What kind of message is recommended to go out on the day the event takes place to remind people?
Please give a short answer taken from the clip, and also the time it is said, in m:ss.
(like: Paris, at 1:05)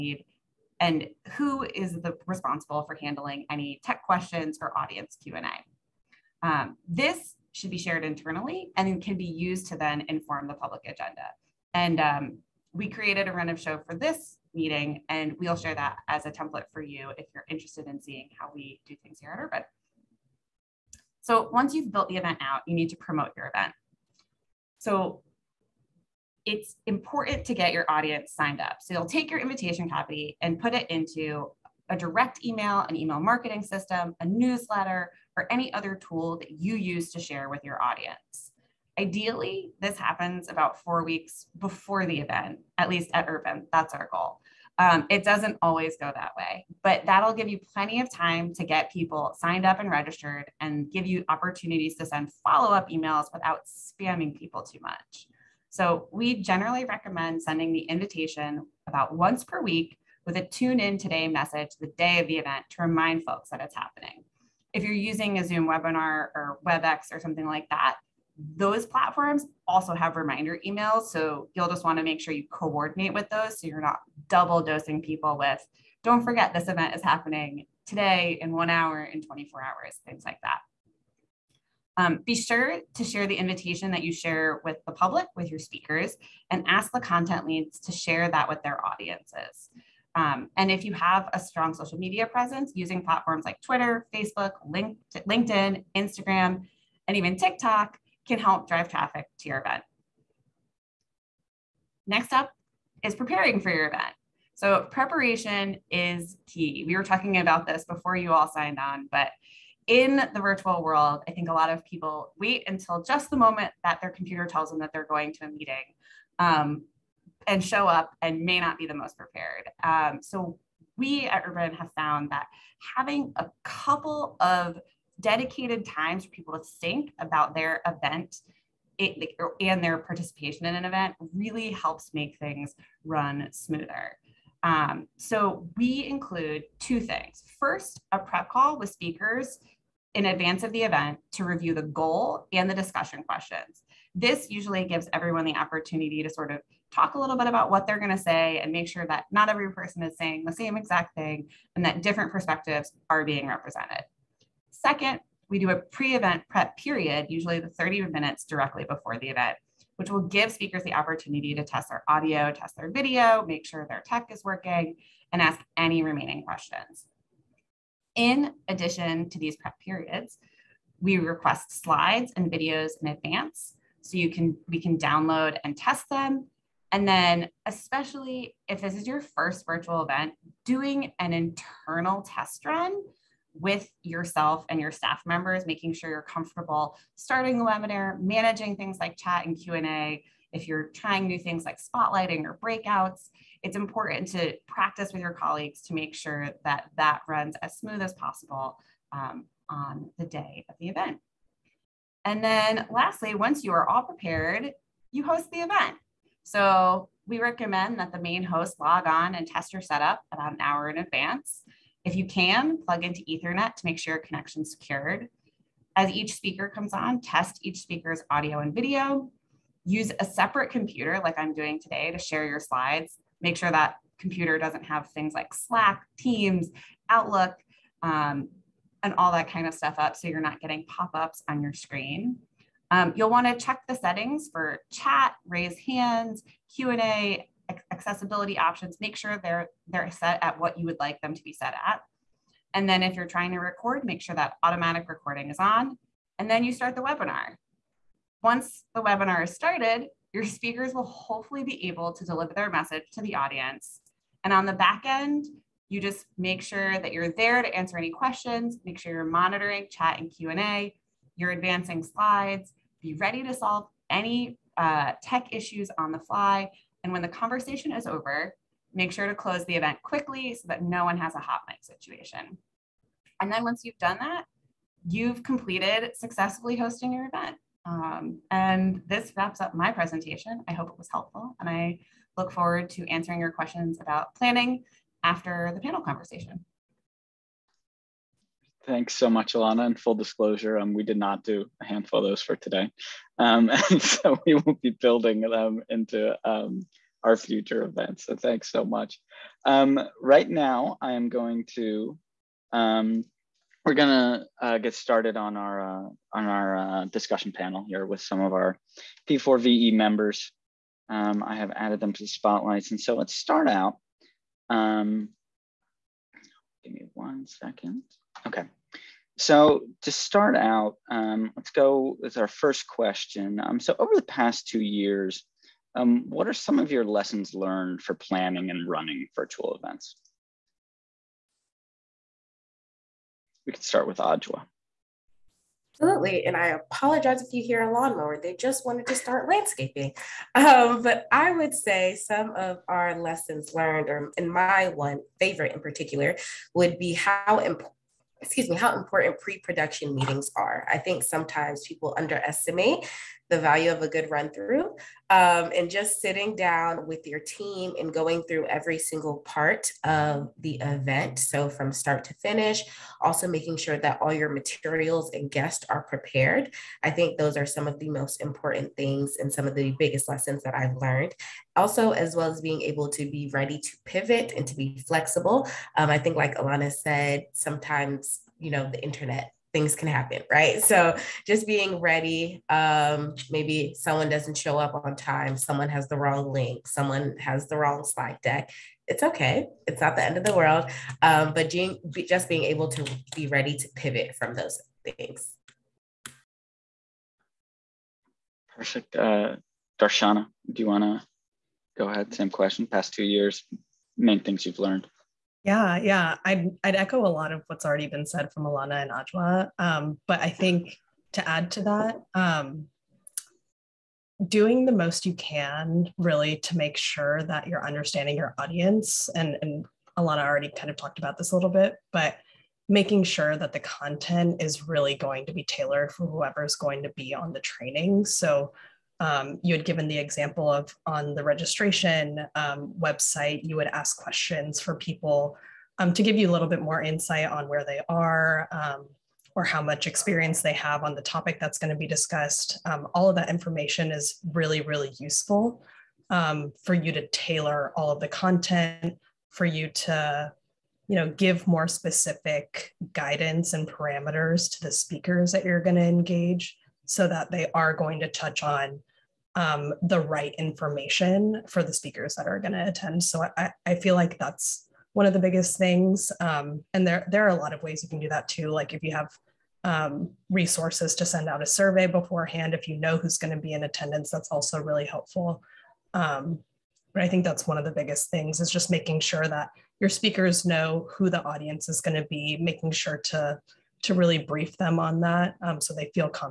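tune in today, at 1:00.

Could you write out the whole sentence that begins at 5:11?
Um, I have added them to the spotlights.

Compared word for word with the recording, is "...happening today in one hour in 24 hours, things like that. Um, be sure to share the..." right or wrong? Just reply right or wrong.
right.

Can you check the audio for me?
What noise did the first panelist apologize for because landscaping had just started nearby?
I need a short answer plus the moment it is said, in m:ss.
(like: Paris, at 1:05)
a lawnmower, at 5:37.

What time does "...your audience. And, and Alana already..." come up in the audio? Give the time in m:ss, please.
6:58.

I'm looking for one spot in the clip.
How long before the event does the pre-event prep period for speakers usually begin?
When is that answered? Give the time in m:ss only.
2:37.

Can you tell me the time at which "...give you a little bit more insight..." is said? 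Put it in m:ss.
7:16.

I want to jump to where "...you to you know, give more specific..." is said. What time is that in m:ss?
7:29.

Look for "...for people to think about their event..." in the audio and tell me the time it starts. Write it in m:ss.
2:06.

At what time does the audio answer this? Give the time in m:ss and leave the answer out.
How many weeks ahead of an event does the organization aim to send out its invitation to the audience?
0:40.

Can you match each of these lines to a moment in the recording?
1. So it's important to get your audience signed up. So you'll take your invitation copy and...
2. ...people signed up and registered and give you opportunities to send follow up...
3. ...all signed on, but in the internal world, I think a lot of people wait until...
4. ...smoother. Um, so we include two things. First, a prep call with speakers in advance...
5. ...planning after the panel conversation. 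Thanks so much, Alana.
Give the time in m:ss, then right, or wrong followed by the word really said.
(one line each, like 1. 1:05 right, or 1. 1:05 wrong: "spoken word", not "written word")
1. 0:24 right
2. 0:48 right
3. 1:48 wrong: "virtual", not "internal"
4. 2:13 right
5. 4:44 right.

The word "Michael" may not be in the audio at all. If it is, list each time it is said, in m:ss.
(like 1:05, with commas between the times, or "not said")
not said.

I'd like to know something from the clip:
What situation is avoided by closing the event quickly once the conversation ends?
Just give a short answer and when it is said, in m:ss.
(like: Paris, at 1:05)
hot mic, at 4:31.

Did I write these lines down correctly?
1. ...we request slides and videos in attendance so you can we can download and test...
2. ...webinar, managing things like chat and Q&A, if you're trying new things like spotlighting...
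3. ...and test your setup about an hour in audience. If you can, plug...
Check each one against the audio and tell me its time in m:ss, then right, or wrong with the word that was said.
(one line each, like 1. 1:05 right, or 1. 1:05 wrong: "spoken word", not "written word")
1. 2:50 wrong: "advance", not "attendance"
2. 3:07 right
3. 3:29 wrong: "advance", not "audience".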